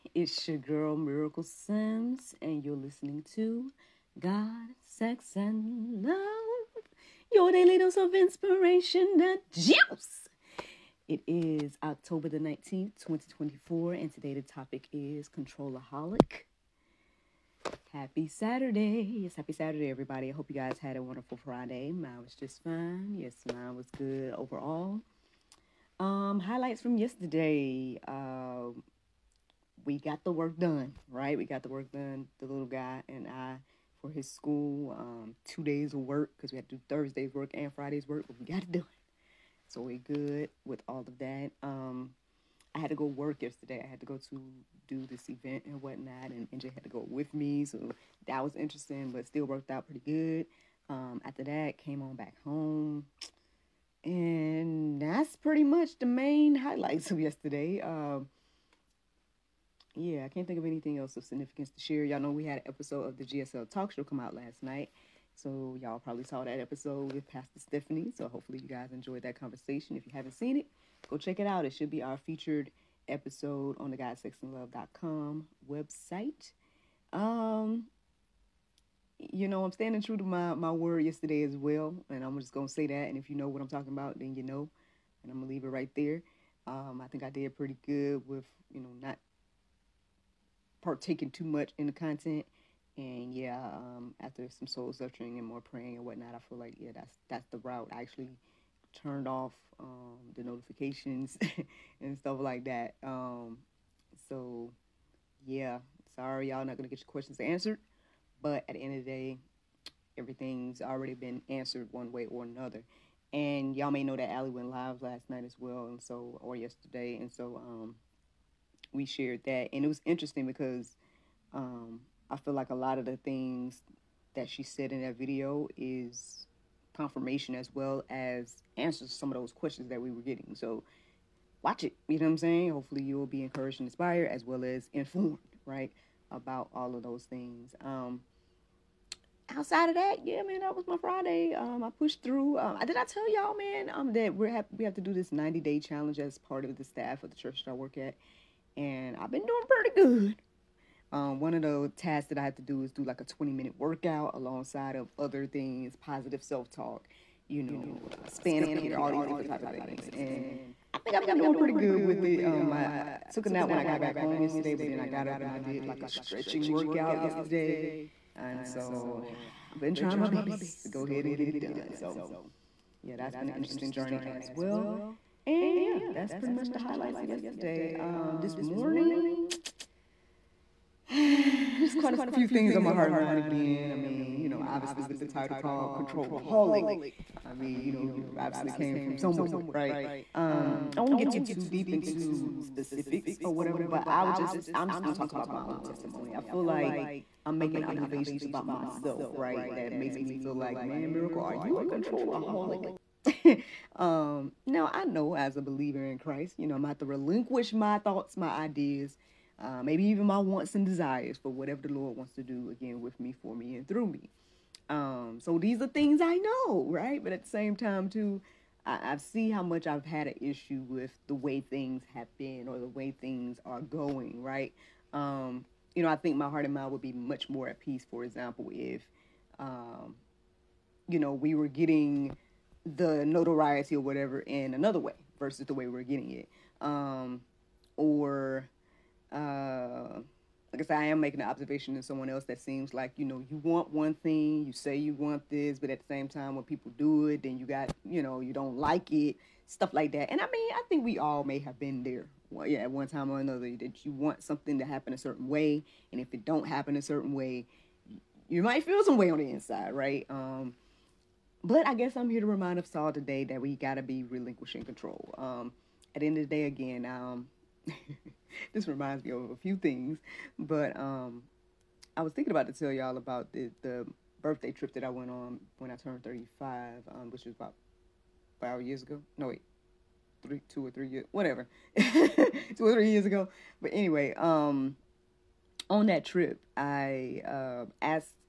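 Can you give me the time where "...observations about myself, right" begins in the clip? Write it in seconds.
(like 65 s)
197 s.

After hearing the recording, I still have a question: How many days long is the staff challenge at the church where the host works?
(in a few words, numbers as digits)
90.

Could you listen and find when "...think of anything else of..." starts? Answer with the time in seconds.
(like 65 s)
60 s.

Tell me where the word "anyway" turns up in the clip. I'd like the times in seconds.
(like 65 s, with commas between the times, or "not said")
283 s.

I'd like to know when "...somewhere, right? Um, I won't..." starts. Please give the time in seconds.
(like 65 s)
189 s.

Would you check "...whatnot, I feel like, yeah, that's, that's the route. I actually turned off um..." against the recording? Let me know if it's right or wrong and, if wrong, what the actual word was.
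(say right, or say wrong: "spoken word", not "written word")
right.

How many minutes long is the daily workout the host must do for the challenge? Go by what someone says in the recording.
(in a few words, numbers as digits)
20.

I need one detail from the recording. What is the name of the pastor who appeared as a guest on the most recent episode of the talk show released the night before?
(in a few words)
Pastor Stephanie.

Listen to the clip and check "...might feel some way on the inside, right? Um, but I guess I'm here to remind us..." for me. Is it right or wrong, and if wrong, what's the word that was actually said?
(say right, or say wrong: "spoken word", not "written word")
right.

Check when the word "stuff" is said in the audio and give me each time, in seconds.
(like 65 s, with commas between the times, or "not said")
102 s, 249 s.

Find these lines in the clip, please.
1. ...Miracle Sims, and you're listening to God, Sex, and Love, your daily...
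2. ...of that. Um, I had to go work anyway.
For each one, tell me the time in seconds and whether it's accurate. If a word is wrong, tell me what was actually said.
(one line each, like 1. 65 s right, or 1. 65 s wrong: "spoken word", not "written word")
1. 0 s right
2. 41 s wrong: "yesterday", not "anyway".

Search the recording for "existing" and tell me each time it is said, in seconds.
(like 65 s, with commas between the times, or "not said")
not said.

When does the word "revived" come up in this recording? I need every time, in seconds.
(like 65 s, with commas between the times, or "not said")
not said.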